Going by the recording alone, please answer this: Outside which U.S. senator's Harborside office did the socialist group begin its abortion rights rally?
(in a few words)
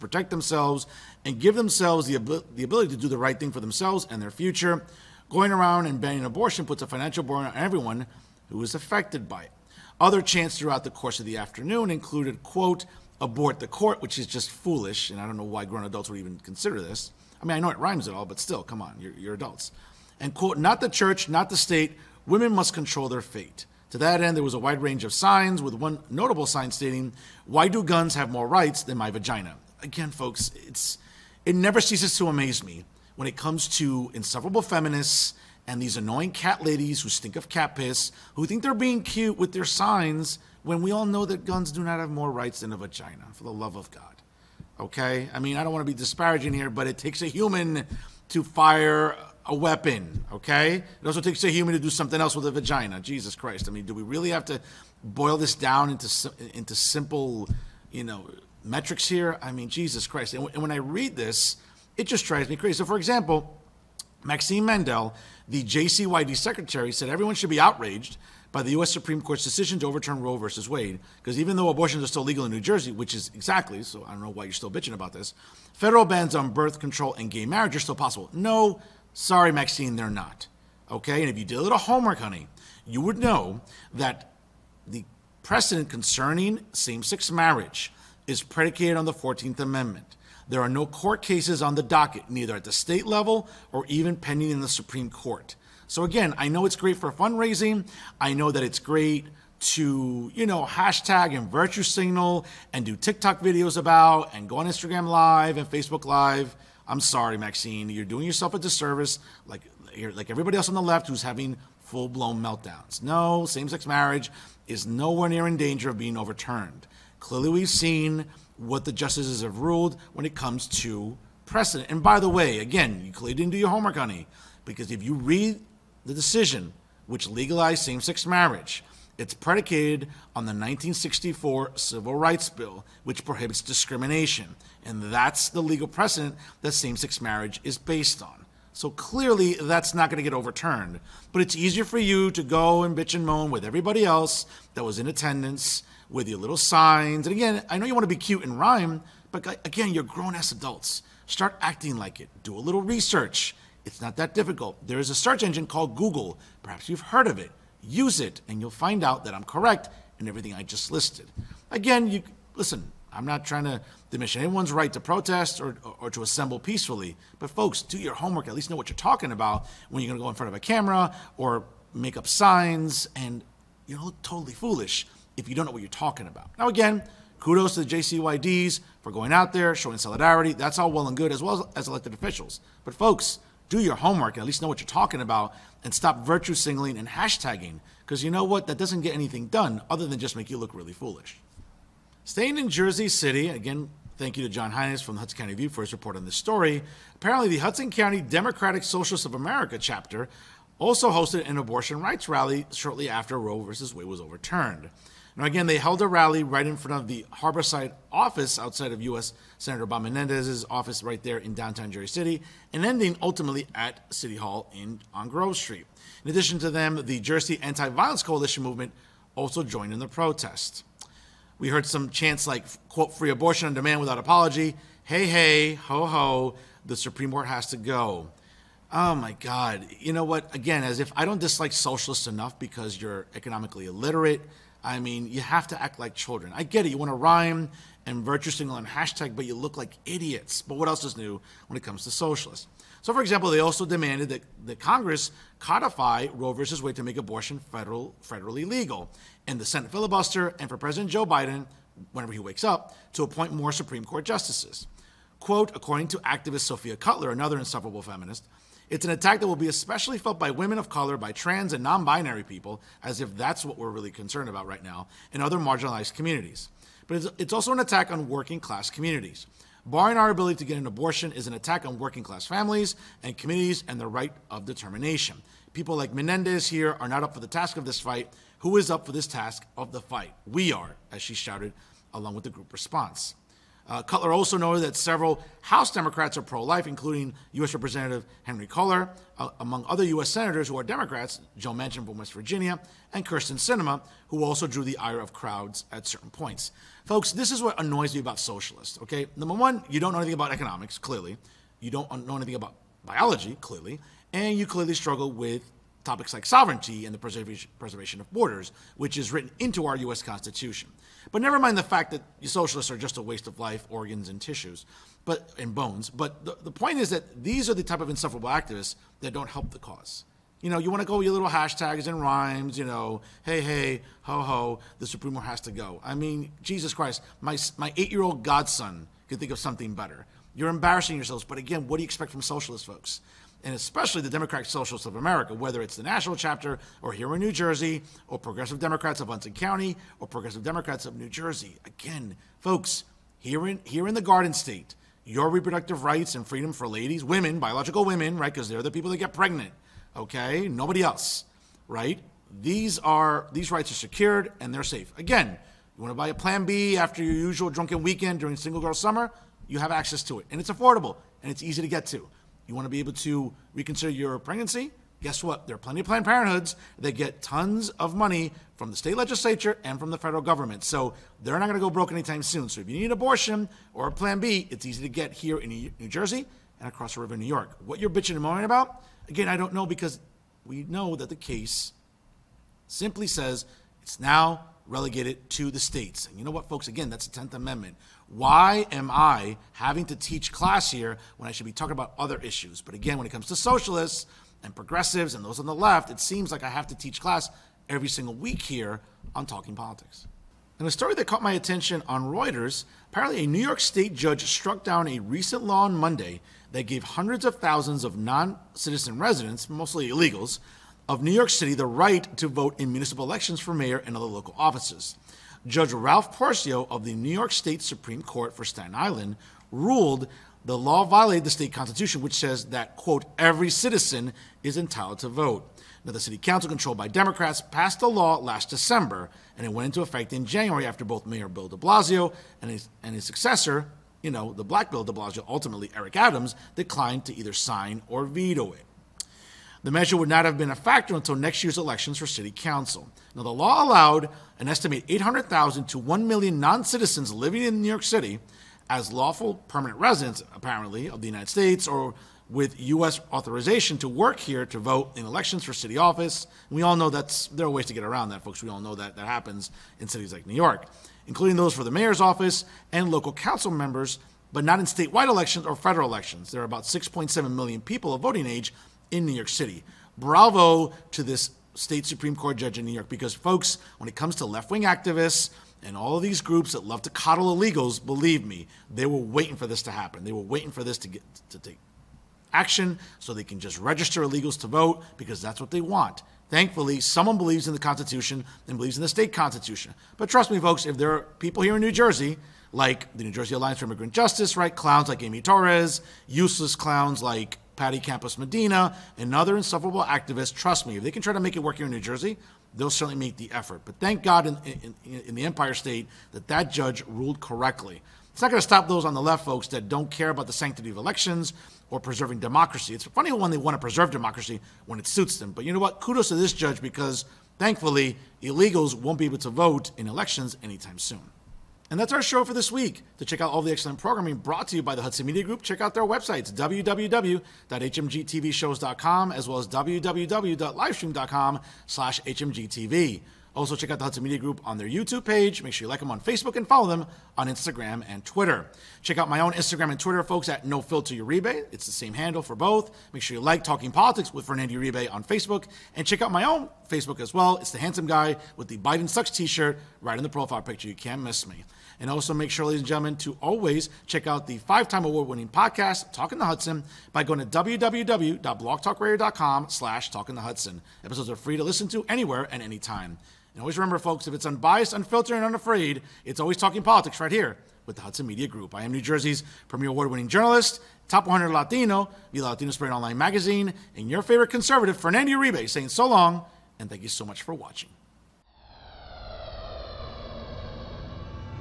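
Bob Menendez.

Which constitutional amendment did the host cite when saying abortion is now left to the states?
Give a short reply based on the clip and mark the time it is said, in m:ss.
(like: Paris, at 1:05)
10th Amendment, at 6:27.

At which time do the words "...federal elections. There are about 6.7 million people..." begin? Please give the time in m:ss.
7:45.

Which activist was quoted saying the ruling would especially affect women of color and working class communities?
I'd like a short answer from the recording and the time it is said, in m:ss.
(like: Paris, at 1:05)
Sophia Cutler, at 4:16.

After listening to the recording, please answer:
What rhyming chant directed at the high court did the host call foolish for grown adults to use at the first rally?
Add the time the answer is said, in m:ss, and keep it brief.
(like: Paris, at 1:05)
Abort the court, at 0:13.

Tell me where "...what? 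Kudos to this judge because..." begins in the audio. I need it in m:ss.
8:35.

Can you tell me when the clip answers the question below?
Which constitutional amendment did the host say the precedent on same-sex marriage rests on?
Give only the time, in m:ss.
1:29.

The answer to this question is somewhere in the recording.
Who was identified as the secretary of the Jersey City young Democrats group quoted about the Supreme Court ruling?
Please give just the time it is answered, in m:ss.
1:04.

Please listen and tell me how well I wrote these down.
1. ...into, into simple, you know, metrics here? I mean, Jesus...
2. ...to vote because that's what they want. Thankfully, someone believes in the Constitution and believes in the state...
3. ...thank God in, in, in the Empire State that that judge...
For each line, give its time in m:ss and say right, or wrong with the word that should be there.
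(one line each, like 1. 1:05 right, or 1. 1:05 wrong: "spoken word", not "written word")
1. 0:55 right
2. 8:04 right
3. 8:23 right.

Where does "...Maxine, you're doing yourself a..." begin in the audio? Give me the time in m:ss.
1:47.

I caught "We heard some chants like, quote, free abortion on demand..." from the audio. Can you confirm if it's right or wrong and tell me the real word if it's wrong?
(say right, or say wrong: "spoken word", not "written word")
right.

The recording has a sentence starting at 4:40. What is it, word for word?
We are, as she shouted, along with the group response.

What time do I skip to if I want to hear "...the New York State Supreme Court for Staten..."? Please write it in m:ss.
6:57.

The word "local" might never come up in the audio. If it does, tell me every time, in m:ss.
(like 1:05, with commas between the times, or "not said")
6:54, 7:43.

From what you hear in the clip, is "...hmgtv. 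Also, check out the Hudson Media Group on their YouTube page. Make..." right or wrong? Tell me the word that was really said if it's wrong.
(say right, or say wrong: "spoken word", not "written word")
right.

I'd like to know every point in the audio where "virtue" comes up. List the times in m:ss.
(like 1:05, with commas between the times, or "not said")
1:41, 3:06, 3:58.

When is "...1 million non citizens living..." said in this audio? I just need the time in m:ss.
7:25.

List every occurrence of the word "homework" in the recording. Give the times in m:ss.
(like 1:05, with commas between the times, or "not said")
1:21, 2:03, 2:48, 3:03.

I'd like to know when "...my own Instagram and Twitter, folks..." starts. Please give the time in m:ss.
8:59.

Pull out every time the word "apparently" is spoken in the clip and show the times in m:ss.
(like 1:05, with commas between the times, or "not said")
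3:17, 6:43, 7:30.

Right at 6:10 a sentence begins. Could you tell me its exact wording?
So they're not going to go broke anytime soon.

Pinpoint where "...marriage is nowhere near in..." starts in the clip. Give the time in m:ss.
1:53.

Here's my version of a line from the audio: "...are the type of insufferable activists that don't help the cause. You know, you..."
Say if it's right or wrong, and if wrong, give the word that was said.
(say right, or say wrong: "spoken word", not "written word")
right.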